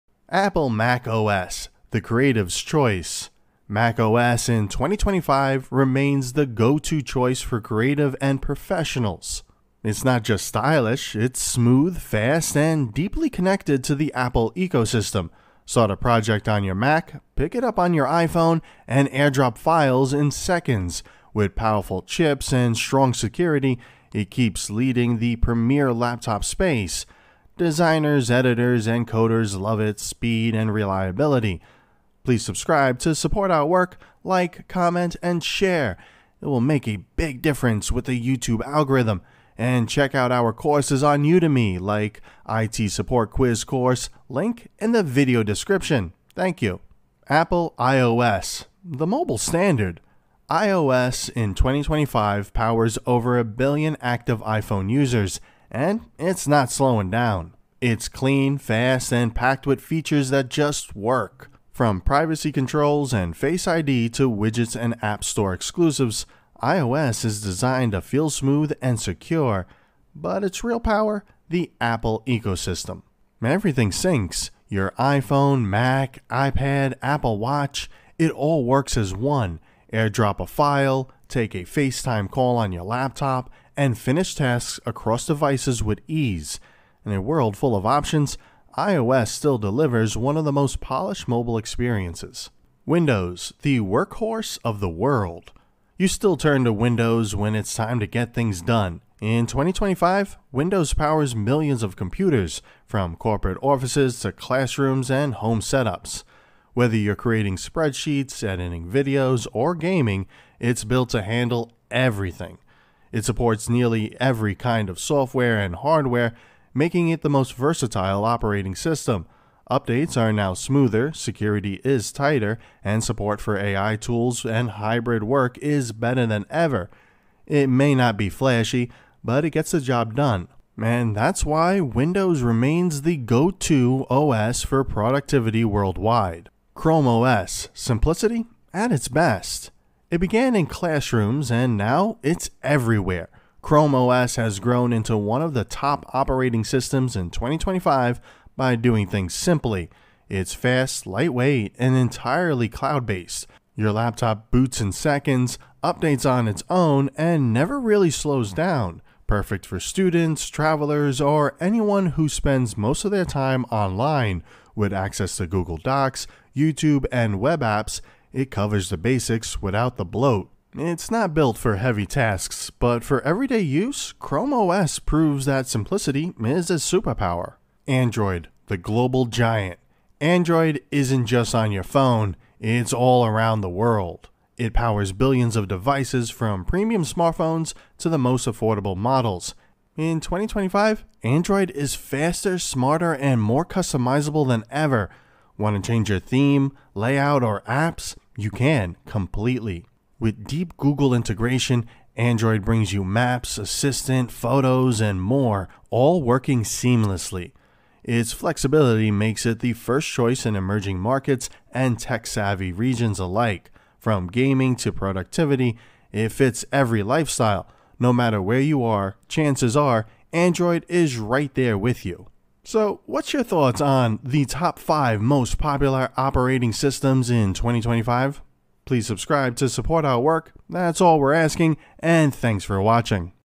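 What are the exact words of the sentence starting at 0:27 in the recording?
Designers, editors, and coders love its speed and reliability.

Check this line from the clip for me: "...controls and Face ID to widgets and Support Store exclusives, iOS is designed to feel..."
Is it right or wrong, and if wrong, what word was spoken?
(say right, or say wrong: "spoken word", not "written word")
wrong: "App", not "Support".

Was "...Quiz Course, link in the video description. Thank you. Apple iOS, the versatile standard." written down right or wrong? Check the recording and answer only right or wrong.
wrong.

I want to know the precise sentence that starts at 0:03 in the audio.
Mac OS in 2025 remains the go to choice for creative and professionals.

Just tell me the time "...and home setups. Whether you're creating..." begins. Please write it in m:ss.
1:45.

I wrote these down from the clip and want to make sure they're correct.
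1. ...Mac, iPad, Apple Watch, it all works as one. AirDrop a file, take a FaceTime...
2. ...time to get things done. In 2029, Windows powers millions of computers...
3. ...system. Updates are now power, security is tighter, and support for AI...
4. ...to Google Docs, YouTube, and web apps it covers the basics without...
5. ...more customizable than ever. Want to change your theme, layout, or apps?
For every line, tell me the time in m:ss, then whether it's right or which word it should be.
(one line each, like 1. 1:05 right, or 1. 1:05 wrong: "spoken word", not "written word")
1. 1:15 right
2. 1:37 wrong: "2025", not "2029"
3. 1:58 wrong: "smoother", not "power"
4. 2:45 right
5. 3:13 right.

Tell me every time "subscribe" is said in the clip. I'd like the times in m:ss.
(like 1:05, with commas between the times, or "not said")
0:32, 3:49.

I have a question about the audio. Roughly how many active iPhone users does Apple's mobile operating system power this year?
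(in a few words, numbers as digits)
over a billion.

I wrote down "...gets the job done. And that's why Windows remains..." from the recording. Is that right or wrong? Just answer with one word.
right.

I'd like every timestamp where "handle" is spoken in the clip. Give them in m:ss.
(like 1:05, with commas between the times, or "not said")
1:51.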